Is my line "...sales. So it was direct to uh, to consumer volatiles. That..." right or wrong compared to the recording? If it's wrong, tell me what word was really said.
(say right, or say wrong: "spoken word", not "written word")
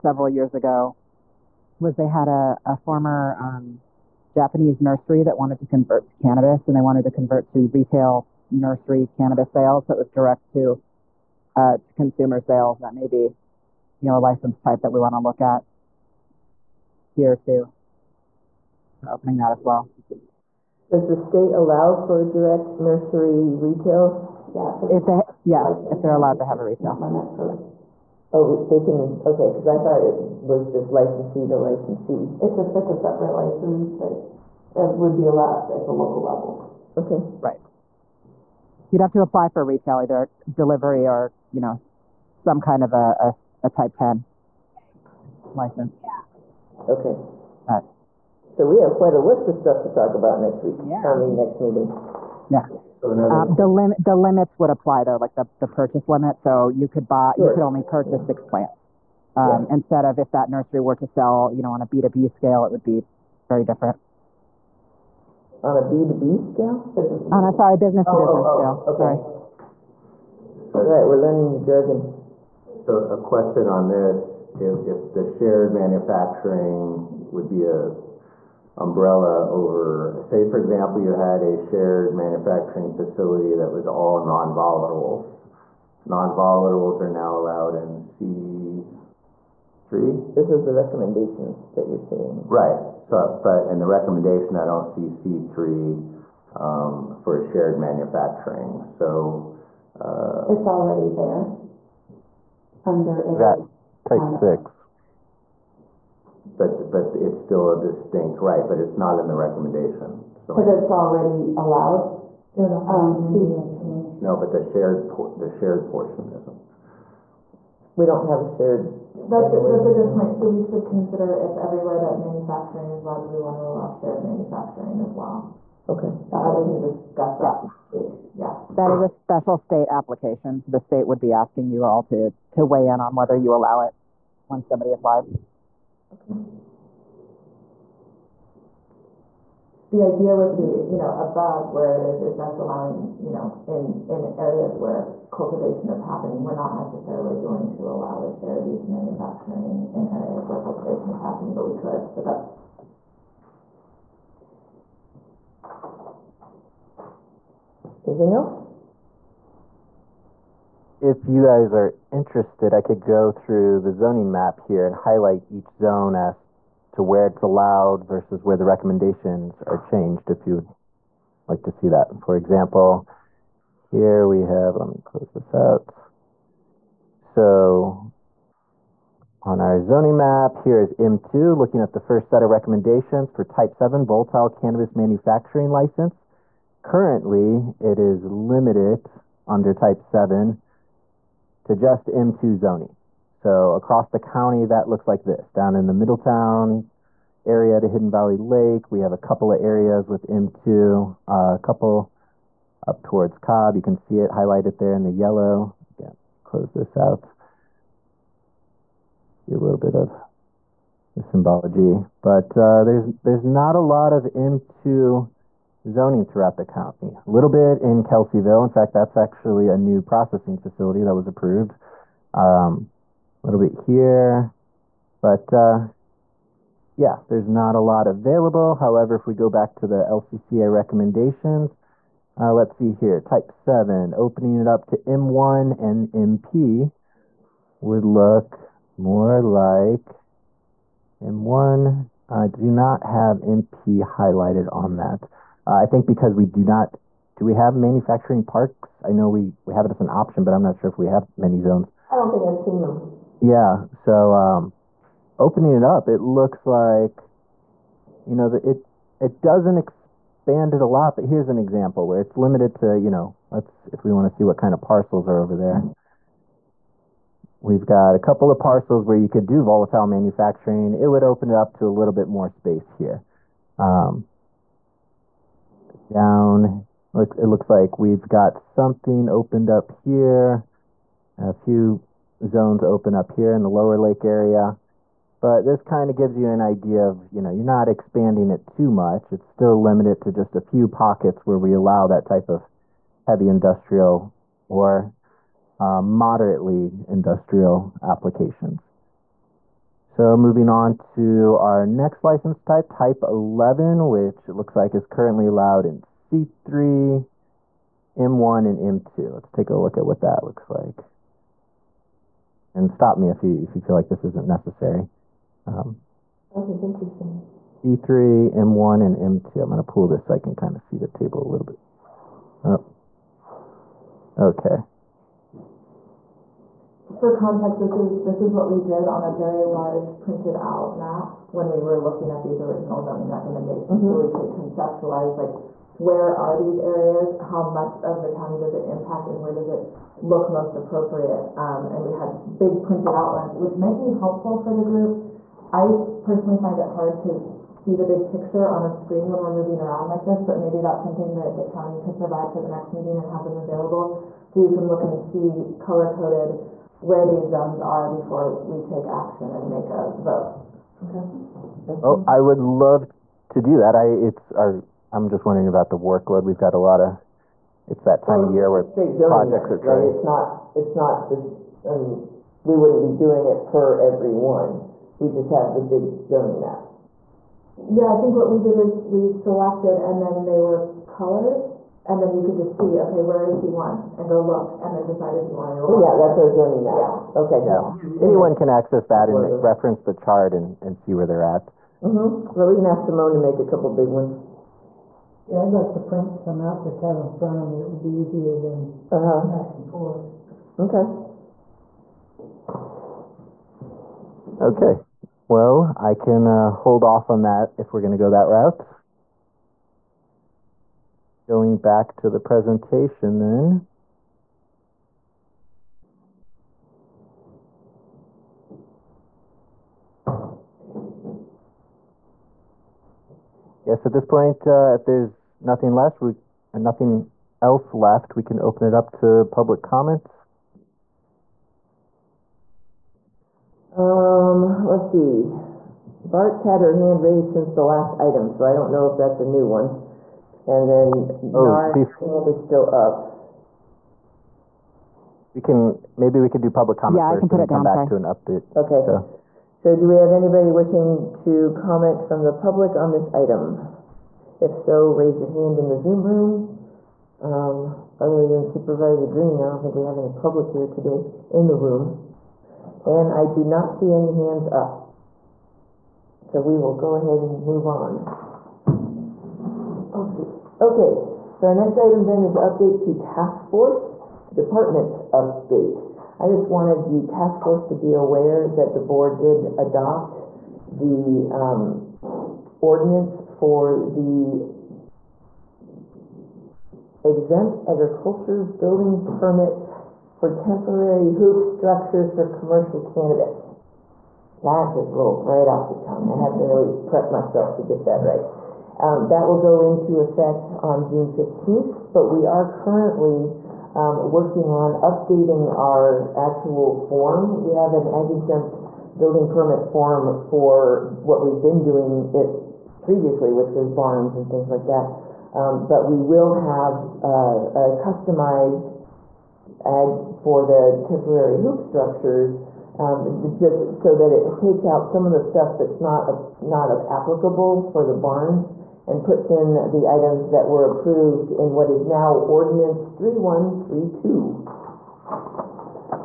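wrong: "sales", not "volatiles".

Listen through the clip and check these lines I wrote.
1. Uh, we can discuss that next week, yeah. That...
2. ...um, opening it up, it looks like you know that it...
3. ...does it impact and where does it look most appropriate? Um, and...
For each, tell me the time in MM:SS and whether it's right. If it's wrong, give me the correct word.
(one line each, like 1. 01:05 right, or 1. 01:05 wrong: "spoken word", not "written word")
1. 02:06 right
2. 04:14 right
3. 05:38 right.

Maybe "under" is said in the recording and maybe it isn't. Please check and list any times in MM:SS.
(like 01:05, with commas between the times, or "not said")
01:42, 03:09.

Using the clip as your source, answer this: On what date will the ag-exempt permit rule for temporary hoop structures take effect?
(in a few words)
June 15.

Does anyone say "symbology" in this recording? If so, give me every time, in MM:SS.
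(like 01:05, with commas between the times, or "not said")
03:31.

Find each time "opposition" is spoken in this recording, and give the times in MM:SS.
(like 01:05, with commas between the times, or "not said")
not said.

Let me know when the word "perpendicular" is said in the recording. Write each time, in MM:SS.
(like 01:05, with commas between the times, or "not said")
not said.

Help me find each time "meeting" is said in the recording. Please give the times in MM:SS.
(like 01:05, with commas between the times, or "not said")
00:51, 05:52.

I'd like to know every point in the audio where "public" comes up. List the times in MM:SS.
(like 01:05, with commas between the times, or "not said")
07:09, 07:26, 07:32, 07:40.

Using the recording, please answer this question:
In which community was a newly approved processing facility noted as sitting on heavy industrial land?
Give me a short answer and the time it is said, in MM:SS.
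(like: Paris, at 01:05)
Kelseyville, at 03:38.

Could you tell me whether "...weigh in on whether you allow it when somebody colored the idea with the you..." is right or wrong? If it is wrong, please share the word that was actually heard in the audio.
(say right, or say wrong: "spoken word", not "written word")
wrong: "applied", not "colored".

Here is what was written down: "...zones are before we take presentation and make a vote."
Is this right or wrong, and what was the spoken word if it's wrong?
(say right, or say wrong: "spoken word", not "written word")
wrong: "action", not "presentation".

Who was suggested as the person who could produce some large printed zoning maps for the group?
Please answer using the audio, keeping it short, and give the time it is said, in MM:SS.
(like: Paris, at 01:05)
Simone, at 06:33.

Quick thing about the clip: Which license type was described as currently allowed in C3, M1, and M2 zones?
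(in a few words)
Type 11.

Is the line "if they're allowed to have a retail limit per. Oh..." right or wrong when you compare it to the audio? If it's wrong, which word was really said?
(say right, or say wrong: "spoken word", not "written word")
right.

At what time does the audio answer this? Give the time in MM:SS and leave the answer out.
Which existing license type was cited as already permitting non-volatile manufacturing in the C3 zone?
01:44.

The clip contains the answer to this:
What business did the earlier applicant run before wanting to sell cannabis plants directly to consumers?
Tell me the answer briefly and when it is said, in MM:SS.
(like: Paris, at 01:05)
Japanese nursery, at 00:04.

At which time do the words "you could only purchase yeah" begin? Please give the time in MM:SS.
00:57.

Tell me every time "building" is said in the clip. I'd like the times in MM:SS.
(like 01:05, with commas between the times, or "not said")
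08:08, 08:29.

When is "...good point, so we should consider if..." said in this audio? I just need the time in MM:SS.
01:59.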